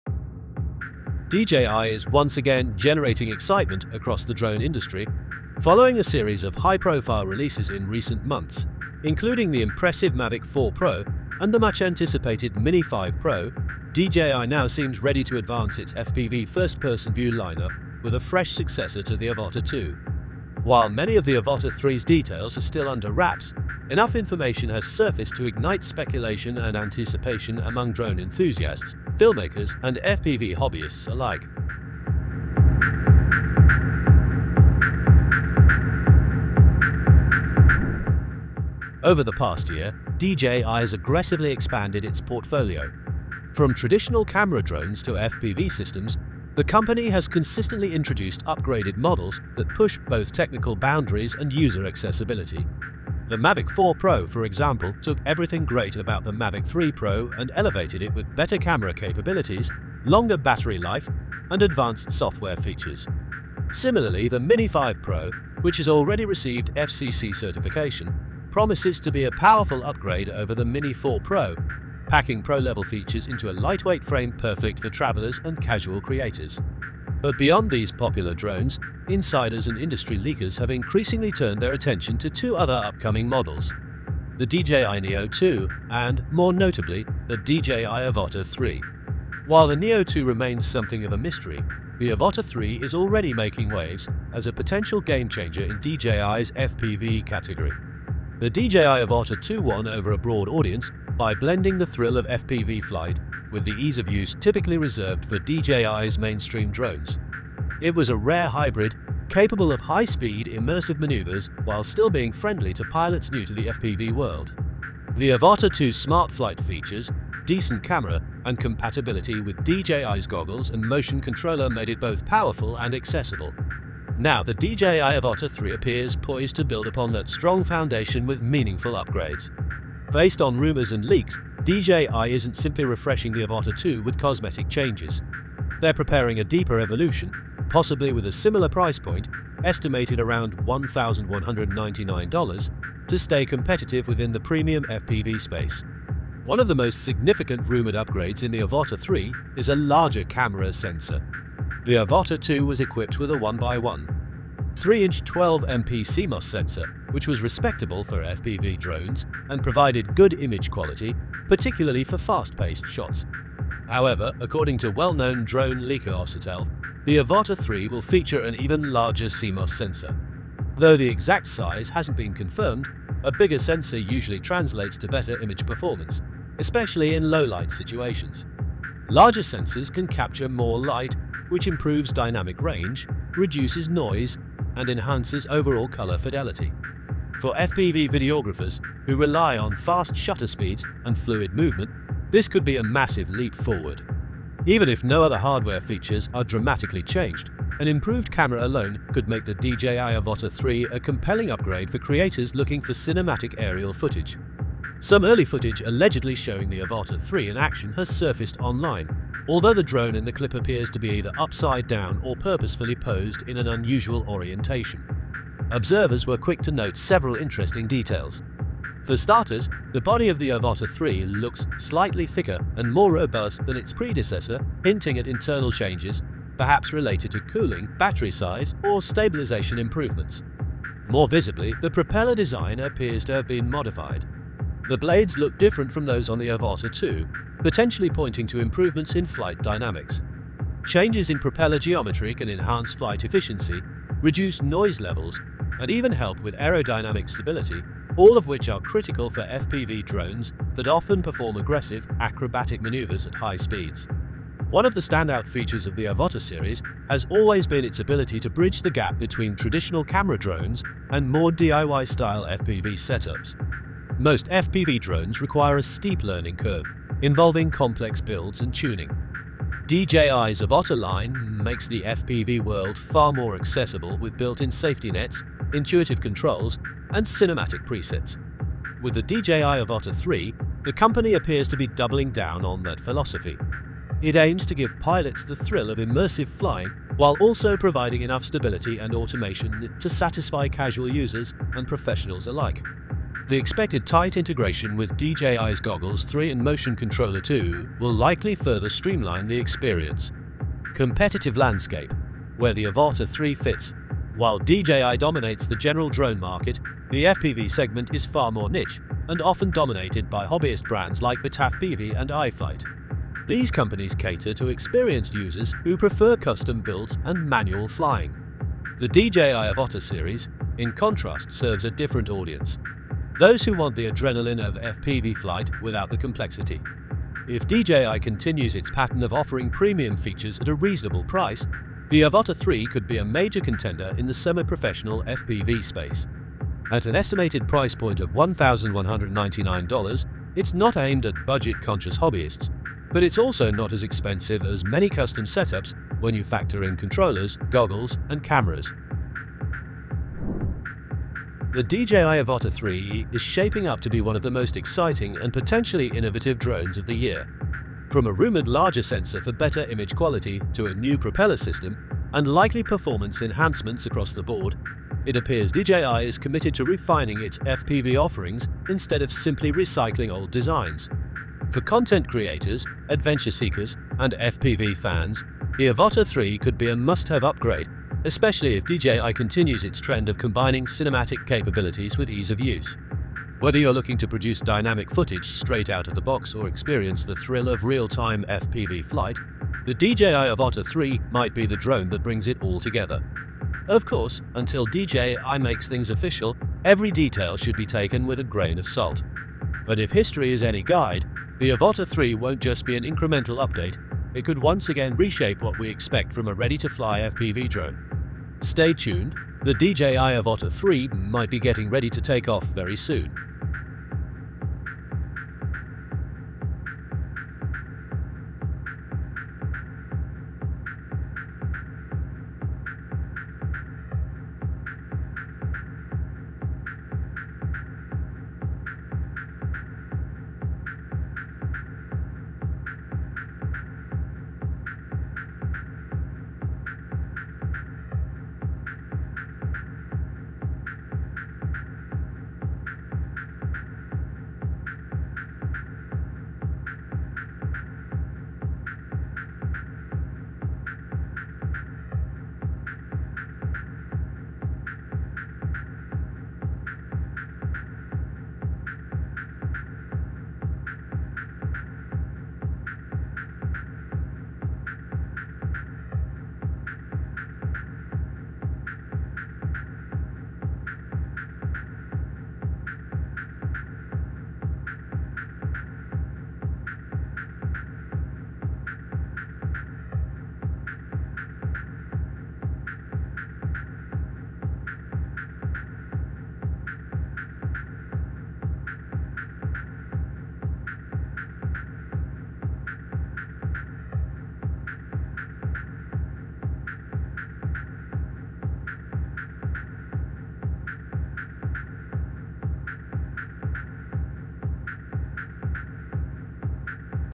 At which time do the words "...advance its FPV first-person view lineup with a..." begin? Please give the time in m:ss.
0:15.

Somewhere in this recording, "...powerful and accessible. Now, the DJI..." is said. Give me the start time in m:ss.
2:02.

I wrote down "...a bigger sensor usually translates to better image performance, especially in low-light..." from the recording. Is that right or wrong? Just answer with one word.
right.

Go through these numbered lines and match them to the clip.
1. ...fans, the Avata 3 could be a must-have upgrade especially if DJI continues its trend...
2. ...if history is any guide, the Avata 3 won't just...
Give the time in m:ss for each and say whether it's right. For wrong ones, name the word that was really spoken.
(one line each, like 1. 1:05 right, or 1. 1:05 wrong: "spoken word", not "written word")
1. 6:14 right
2. 6:39 right.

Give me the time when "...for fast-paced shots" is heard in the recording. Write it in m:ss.
2:42.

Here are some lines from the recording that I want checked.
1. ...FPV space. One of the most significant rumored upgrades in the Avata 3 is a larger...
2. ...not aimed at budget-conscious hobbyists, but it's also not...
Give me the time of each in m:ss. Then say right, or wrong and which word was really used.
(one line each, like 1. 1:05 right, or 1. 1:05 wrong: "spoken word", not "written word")
1. 2:24 right
2. 5:40 right.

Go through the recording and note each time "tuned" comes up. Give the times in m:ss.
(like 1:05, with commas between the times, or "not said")
6:48.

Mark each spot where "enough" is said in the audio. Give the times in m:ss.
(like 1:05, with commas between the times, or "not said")
0:23, 4:48.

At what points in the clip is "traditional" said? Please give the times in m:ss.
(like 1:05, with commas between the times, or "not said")
0:43, 4:19.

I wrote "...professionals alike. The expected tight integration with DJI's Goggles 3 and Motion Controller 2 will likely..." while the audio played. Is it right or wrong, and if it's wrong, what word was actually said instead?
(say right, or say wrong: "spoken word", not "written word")
right.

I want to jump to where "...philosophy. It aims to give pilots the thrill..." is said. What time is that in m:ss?
4:42.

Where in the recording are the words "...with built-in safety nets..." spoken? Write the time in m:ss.
4:34.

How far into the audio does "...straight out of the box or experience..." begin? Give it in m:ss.
6:25.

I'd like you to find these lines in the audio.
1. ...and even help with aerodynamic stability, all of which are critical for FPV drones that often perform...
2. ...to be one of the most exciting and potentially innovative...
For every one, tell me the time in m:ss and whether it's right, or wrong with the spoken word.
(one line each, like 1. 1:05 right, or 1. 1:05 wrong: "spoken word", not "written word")
1. 4:05 right
2. 5:54 right.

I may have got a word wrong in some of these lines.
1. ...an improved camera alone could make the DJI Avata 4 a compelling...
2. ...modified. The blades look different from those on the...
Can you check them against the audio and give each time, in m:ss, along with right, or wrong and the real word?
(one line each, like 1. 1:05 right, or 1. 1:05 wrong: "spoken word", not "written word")
1. 3:17 wrong: "3", not "4"
2. 3:53 right.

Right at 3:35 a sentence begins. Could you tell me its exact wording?
Observers were quick to note several interesting details.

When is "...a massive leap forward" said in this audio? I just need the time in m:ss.
3:12.